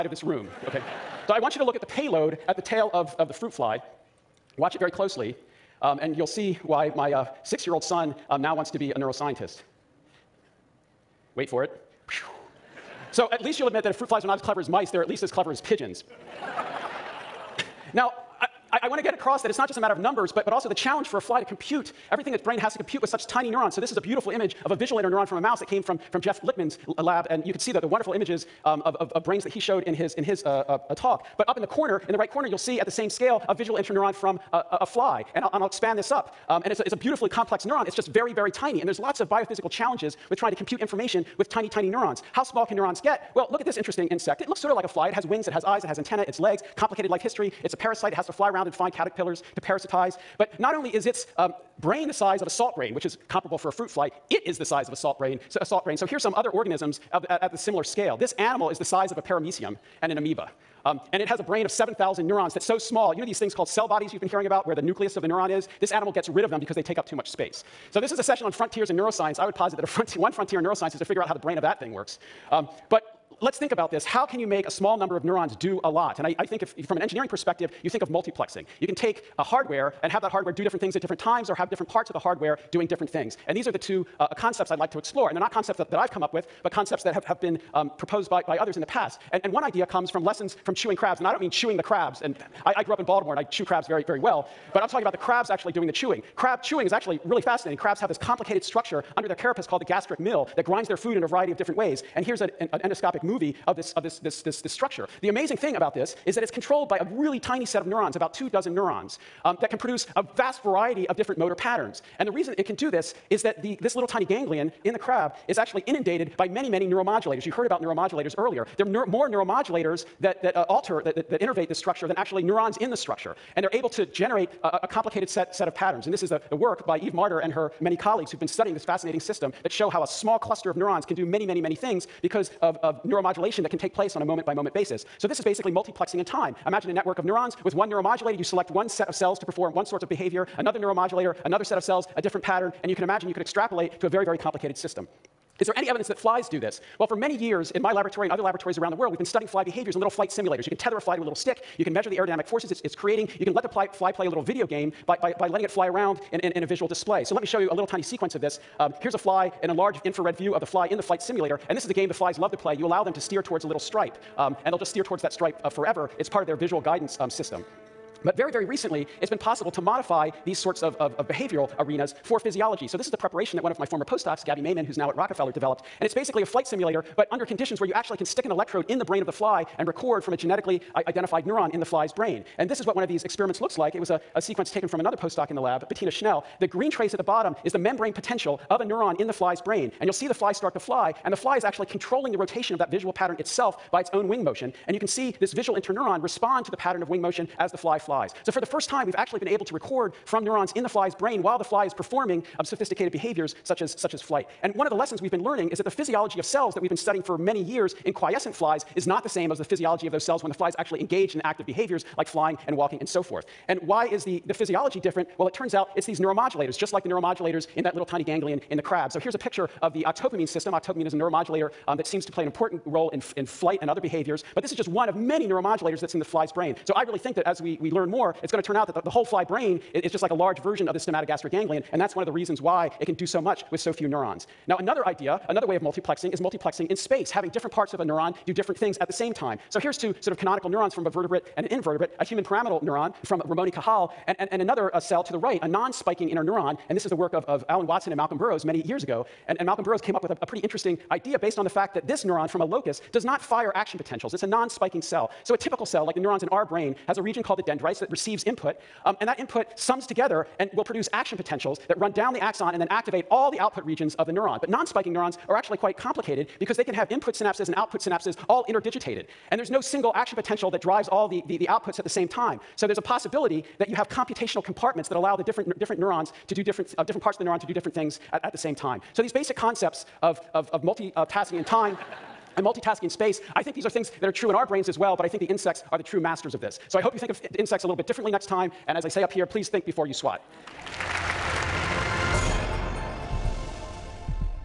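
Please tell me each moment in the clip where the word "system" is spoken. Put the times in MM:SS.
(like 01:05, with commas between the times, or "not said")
02:09, 02:24, 02:47, 03:40.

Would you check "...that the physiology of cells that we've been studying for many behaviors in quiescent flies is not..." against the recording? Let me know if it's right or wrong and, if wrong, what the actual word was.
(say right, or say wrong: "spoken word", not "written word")
wrong: "years", not "behaviors".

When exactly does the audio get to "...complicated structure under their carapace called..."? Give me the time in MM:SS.
01:38.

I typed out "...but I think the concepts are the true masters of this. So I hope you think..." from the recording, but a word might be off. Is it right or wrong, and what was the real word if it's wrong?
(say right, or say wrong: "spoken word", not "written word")
wrong: "insects", not "concepts".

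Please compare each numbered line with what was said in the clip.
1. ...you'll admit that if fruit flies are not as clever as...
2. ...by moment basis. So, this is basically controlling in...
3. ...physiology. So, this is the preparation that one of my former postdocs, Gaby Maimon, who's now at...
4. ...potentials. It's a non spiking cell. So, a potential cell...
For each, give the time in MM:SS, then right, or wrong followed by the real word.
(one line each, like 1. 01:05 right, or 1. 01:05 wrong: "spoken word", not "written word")
1. 00:13 right
2. 02:14 wrong: "multiplexing", not "controlling"
3. 02:52 right
4. 04:13 wrong: "typical", not "potential".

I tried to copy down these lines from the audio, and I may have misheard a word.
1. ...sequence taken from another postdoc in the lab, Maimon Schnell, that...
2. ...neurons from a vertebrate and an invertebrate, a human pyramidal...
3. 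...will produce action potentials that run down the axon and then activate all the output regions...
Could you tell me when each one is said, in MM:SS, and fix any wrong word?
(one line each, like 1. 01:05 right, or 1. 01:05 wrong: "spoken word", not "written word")
1. 03:04 wrong: "Bettina", not "Maimon"
2. 04:00 right
3. 04:20 right.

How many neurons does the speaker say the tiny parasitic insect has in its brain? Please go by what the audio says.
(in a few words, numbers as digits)
7,000.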